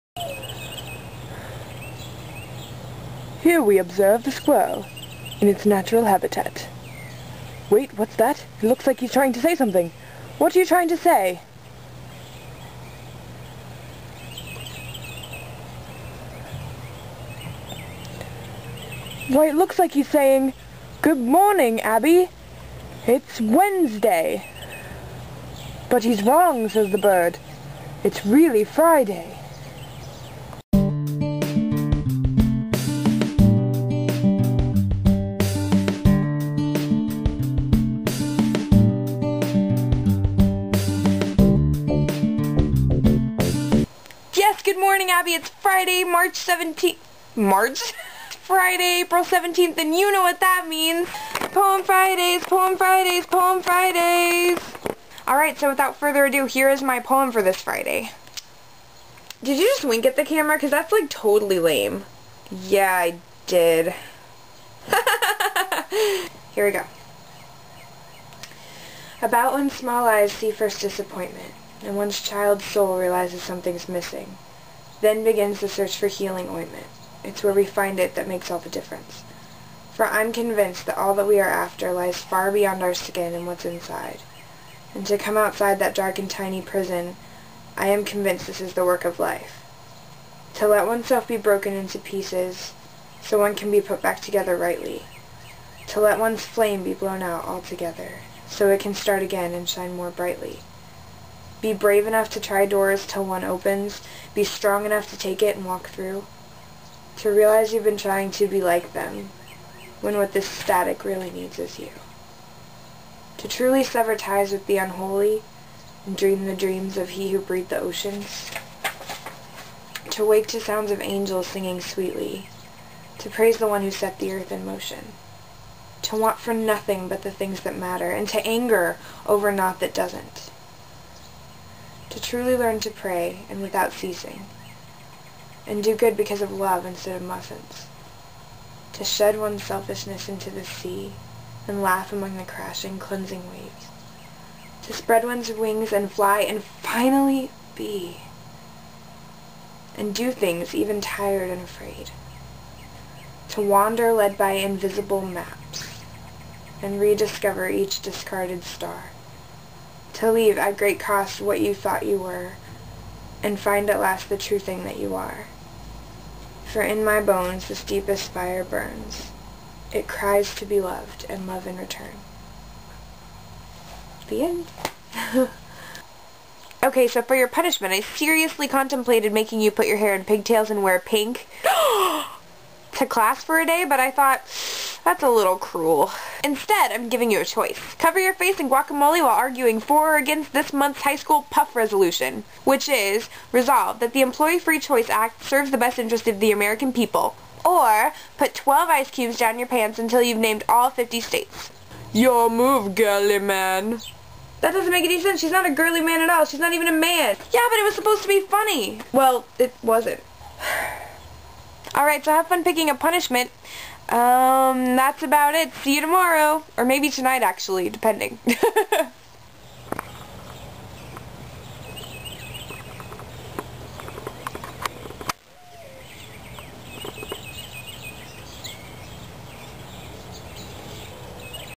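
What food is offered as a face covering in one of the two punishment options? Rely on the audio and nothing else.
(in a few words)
guacamole.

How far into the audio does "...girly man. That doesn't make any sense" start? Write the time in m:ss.
3:22.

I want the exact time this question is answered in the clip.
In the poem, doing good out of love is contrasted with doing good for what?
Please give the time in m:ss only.
2:17.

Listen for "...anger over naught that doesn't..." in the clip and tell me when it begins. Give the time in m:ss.
2:08.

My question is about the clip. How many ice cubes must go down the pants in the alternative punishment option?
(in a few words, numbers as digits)
12.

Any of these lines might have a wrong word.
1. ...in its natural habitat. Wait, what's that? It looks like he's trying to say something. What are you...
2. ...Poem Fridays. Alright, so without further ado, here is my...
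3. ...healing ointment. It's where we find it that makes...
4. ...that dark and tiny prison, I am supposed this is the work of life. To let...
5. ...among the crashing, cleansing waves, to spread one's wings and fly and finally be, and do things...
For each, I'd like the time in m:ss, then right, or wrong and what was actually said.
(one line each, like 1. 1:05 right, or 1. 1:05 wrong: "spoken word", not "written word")
1. 0:05 right
2. 0:53 right
3. 1:16 right
4. 1:25 wrong: "convinced", not "supposed"
5. 2:22 right.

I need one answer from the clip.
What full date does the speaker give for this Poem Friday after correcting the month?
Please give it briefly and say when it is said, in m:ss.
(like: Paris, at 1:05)
April 17th, at 0:48.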